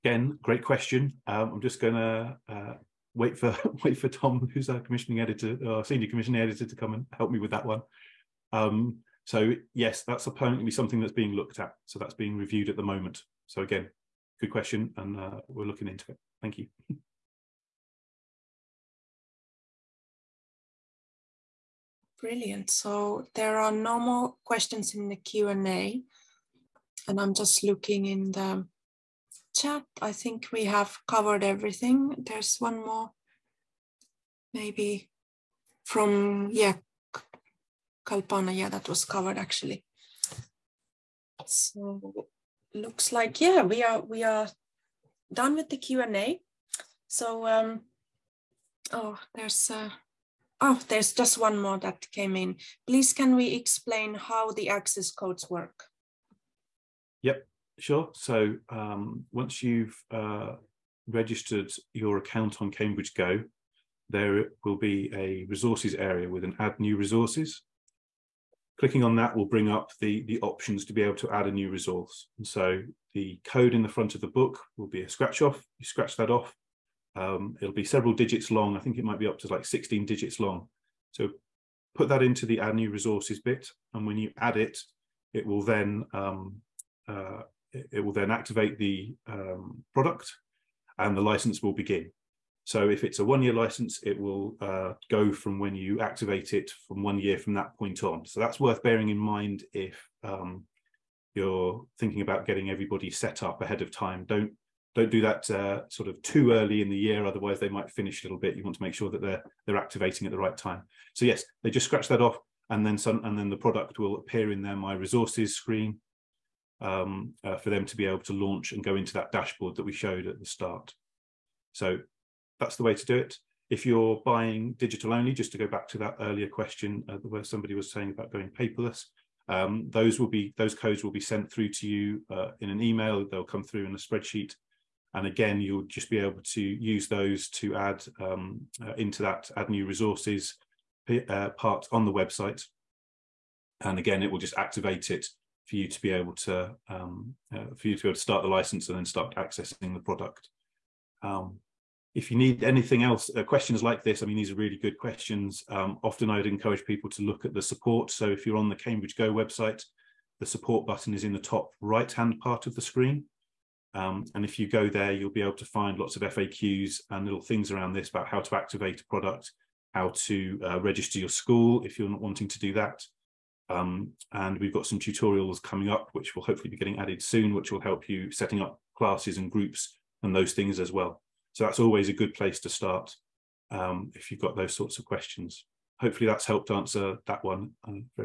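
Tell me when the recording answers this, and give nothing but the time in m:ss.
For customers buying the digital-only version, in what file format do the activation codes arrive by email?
2:13.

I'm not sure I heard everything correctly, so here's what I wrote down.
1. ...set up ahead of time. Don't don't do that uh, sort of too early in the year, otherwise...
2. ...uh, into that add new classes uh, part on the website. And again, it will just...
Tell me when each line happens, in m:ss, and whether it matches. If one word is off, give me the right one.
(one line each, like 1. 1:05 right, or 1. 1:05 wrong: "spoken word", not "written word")
1. 1:43 right
2. 2:18 wrong: "resources", not "classes".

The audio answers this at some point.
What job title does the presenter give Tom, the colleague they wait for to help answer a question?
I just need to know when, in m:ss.
0:05.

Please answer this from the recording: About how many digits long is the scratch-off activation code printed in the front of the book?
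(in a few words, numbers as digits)
16.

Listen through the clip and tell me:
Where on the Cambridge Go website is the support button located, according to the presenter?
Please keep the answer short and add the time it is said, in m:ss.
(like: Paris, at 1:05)
Top right-hand, at 2:41.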